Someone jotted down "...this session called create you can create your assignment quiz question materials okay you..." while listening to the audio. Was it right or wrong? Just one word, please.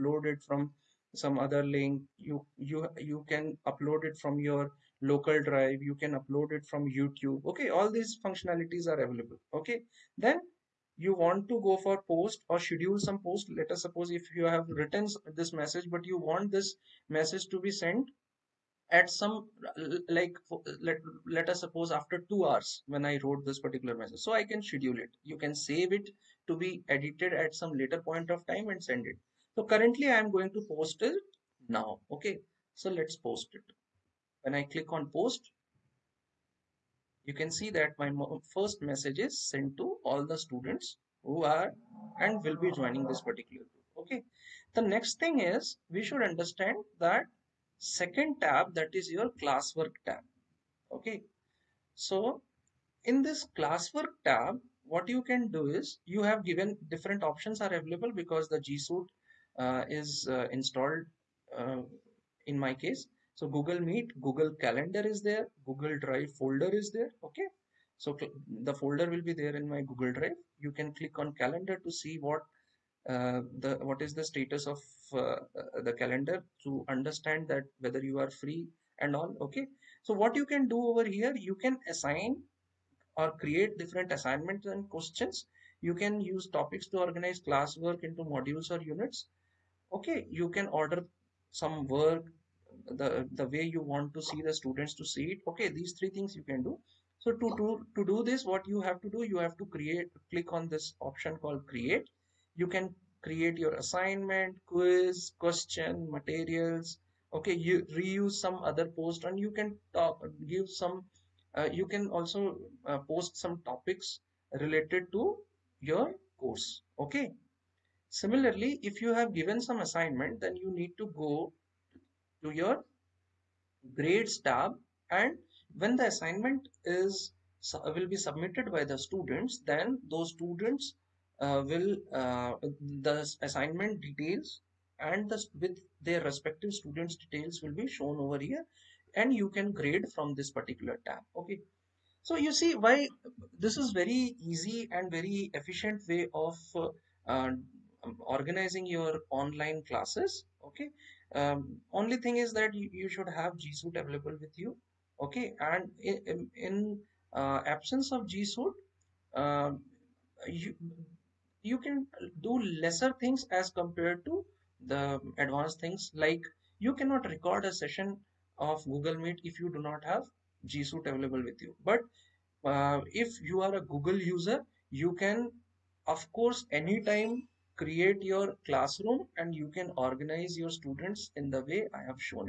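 wrong.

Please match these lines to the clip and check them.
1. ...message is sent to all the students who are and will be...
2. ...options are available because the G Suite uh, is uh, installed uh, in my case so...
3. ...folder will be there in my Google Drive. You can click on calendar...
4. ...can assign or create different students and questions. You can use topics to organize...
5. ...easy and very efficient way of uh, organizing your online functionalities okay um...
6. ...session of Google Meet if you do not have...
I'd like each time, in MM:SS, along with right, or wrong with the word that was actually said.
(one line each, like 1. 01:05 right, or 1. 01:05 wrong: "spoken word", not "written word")
1. 00:38 right
2. 00:57 right
3. 01:08 right
4. 01:21 wrong: "assignments", not "students"
5. 02:24 wrong: "classes", not "functionalities"
6. 02:47 right.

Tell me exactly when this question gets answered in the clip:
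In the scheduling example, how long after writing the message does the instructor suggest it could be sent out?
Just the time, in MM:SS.
00:22.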